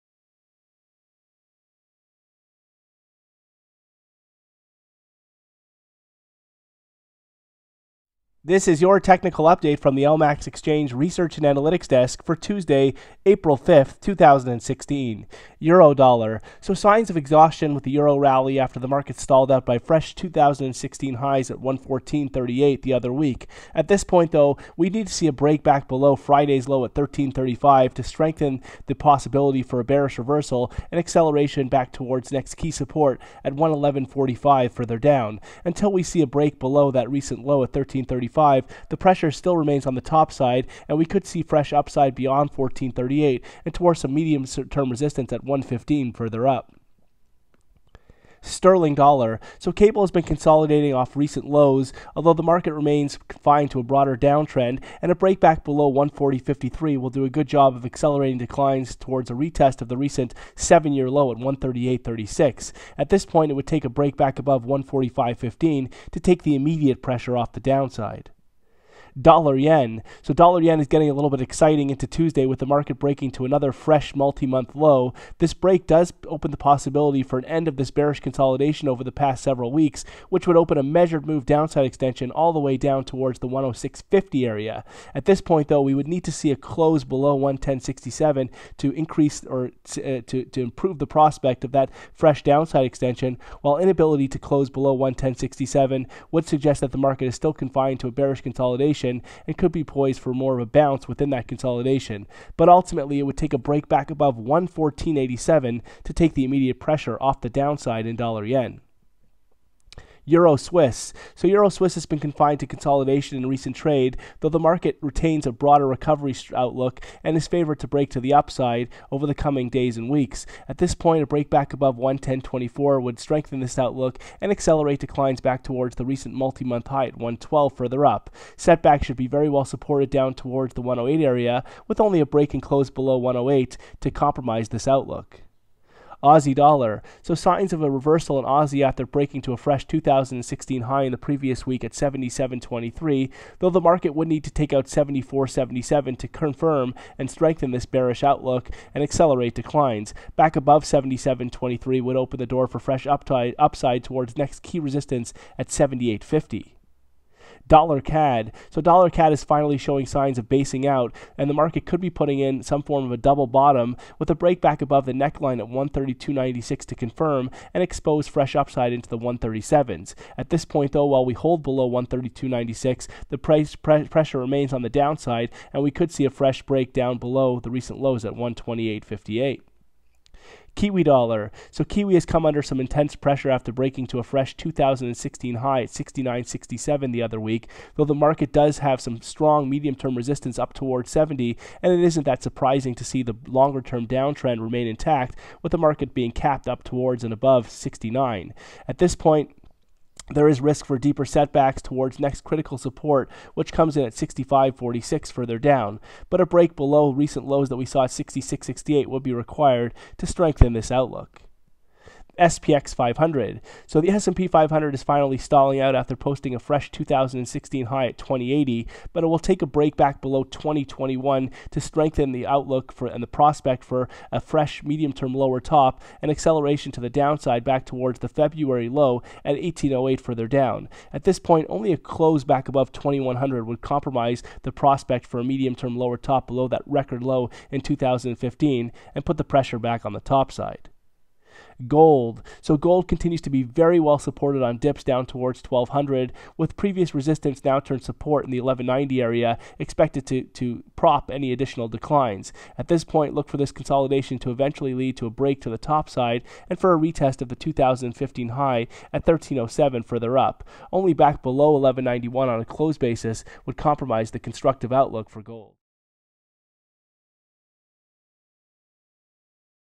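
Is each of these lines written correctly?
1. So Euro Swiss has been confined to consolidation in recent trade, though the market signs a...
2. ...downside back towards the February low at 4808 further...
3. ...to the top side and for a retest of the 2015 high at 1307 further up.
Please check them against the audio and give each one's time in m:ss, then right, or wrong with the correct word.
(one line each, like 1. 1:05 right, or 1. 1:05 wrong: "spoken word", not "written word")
1. 1:51 wrong: "retains", not "signs"
2. 3:47 wrong: "1808", not "4808"
3. 4:15 right.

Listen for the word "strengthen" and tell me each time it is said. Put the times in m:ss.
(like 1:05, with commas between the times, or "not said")
0:28, 2:03, 2:27, 3:30, 3:41.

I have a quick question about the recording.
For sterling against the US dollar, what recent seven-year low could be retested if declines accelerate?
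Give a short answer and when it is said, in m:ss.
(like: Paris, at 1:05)
138.36, at 1:01.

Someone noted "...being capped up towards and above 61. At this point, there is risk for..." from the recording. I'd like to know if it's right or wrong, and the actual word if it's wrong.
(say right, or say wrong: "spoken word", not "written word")
wrong: "69", not "61".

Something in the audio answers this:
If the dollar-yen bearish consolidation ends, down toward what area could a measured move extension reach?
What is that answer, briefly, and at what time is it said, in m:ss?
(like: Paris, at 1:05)
106.50, at 1:23.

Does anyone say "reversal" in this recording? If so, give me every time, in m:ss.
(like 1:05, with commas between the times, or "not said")
0:30, 2:17.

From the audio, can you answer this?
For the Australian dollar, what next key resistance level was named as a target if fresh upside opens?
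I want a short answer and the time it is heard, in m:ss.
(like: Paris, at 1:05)
78.50, at 2:35.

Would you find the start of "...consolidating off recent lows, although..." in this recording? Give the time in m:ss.
0:50.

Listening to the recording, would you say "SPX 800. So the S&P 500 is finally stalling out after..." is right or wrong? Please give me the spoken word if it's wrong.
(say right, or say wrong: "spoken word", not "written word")
wrong: "500", not "800".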